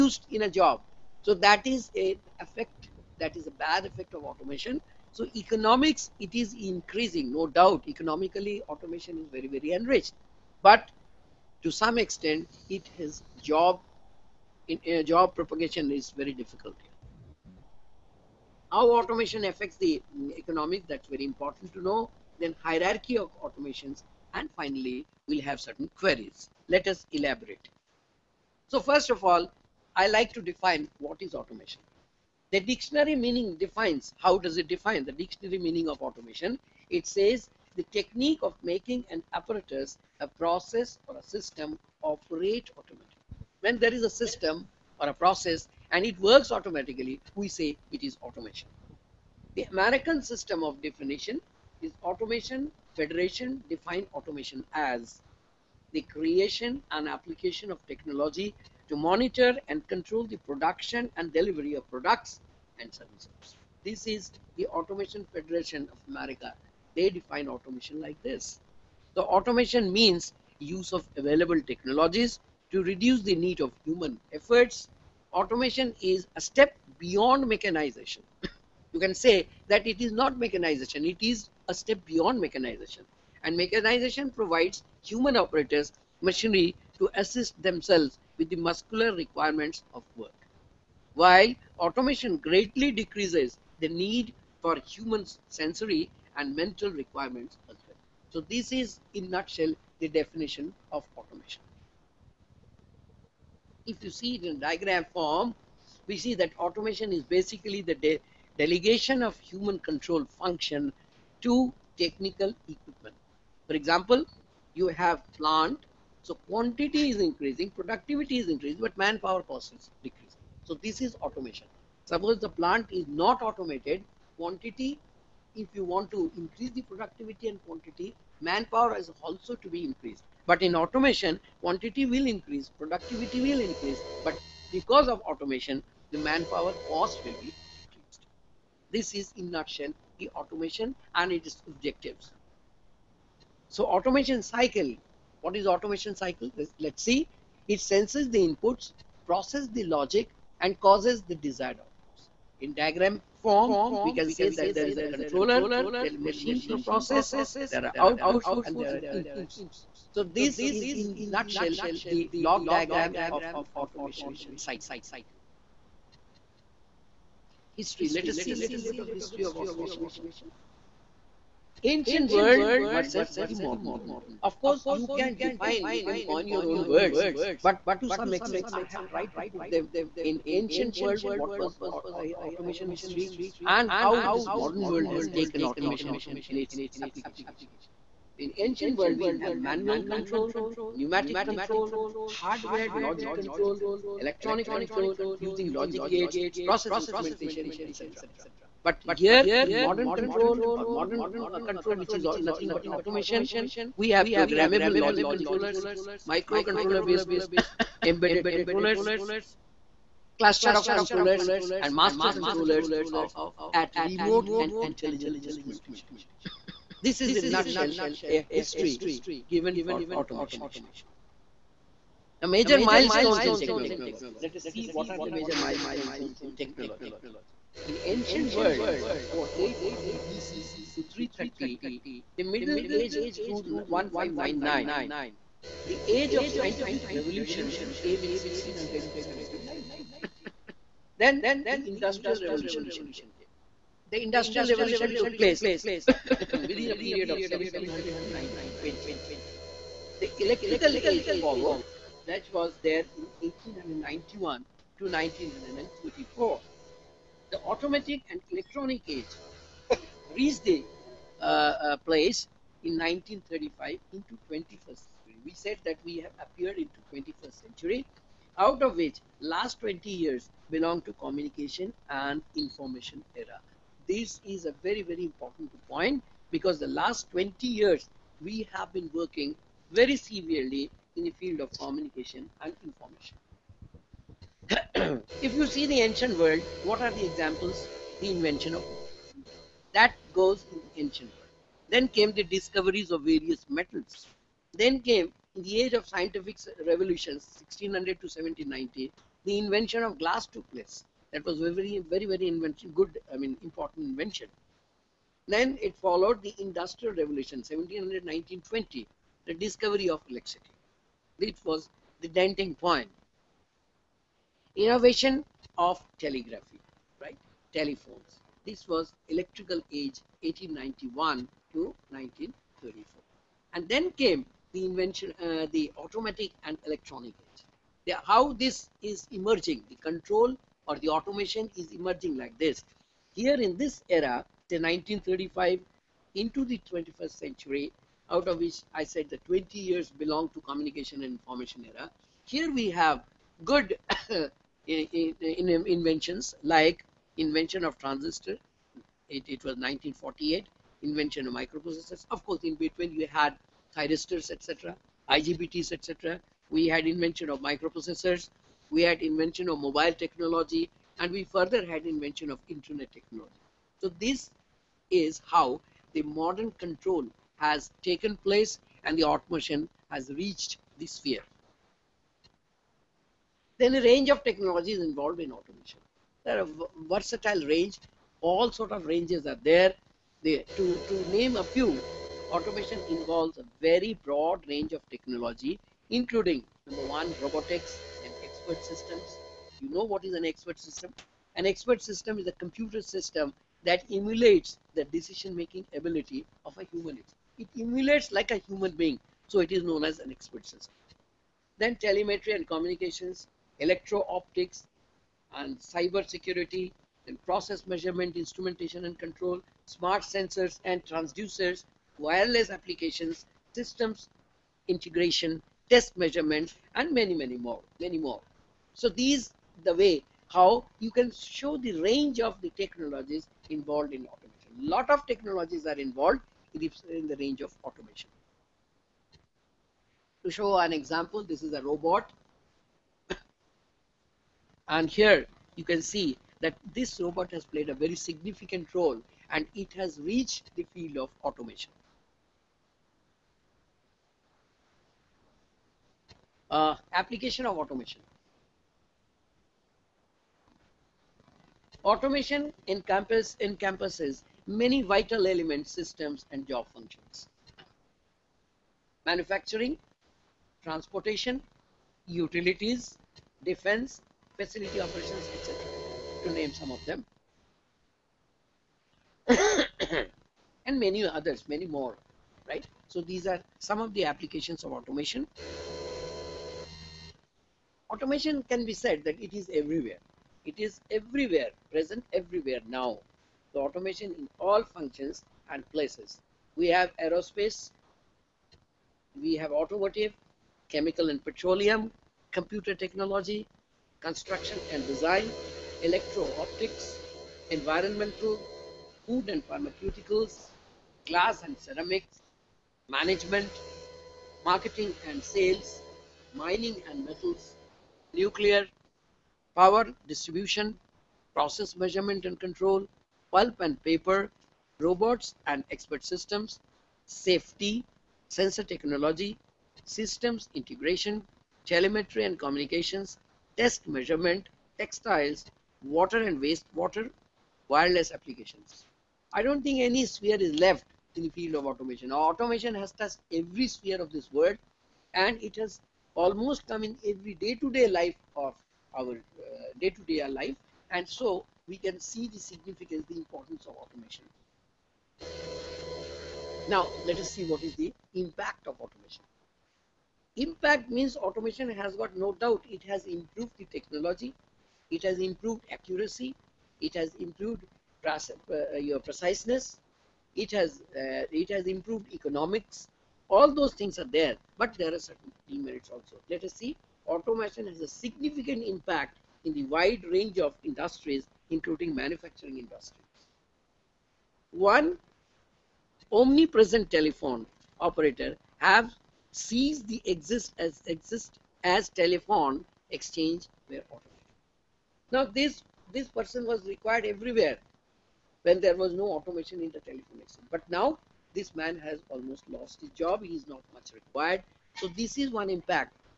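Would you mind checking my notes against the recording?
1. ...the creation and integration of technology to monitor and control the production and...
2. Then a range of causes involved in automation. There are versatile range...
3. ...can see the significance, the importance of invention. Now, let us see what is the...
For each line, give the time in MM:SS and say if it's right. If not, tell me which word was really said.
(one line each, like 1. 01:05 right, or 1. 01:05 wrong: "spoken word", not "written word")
1. 00:55 wrong: "application", not "integration"
2. 06:13 wrong: "technologies", not "causes"
3. 09:01 wrong: "automation", not "invention".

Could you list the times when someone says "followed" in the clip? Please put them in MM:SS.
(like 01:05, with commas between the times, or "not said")
04:11, 05:05.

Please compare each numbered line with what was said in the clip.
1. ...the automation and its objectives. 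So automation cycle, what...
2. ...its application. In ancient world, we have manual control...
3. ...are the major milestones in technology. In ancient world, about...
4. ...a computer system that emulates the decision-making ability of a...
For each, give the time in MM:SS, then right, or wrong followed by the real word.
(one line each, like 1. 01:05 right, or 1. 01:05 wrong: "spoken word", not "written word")
1. 02:20 right
2. 03:06 right
3. 03:45 right
4. 06:32 right.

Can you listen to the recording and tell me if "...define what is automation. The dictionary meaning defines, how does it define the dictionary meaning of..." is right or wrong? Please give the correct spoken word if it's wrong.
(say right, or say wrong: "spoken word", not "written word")
right.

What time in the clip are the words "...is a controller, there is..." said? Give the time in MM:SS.
02:34.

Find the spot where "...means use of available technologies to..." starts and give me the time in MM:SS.
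01:09.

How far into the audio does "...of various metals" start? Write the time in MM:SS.
04:53.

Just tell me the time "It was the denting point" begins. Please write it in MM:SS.
05:11.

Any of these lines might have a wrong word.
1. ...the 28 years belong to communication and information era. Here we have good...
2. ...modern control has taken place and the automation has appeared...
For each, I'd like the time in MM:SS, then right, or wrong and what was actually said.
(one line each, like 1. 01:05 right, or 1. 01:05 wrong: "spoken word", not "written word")
1. 05:39 wrong: "20", not "28"
2. 06:06 wrong: "reached", not "appeared".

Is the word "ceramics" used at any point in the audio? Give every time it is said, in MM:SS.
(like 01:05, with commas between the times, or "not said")
08:21.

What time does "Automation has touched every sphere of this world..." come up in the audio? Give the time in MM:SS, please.
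08:52.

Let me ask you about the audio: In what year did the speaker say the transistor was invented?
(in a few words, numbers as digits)
1948.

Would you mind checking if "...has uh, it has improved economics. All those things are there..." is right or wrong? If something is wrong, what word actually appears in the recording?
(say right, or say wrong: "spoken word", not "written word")
right.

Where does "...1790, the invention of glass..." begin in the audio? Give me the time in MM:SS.
04:58.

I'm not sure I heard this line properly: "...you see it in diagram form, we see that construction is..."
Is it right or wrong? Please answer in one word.
wrong.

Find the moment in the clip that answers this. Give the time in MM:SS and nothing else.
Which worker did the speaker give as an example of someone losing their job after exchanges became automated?
09:37.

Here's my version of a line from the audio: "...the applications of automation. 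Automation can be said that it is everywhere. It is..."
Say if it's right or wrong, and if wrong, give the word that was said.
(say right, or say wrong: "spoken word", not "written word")
right.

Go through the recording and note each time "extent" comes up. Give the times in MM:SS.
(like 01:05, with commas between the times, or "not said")
00:12, 02:58.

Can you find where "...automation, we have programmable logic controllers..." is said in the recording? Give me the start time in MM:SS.
03:22.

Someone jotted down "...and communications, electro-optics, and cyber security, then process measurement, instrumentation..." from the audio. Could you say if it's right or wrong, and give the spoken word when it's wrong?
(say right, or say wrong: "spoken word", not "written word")
right.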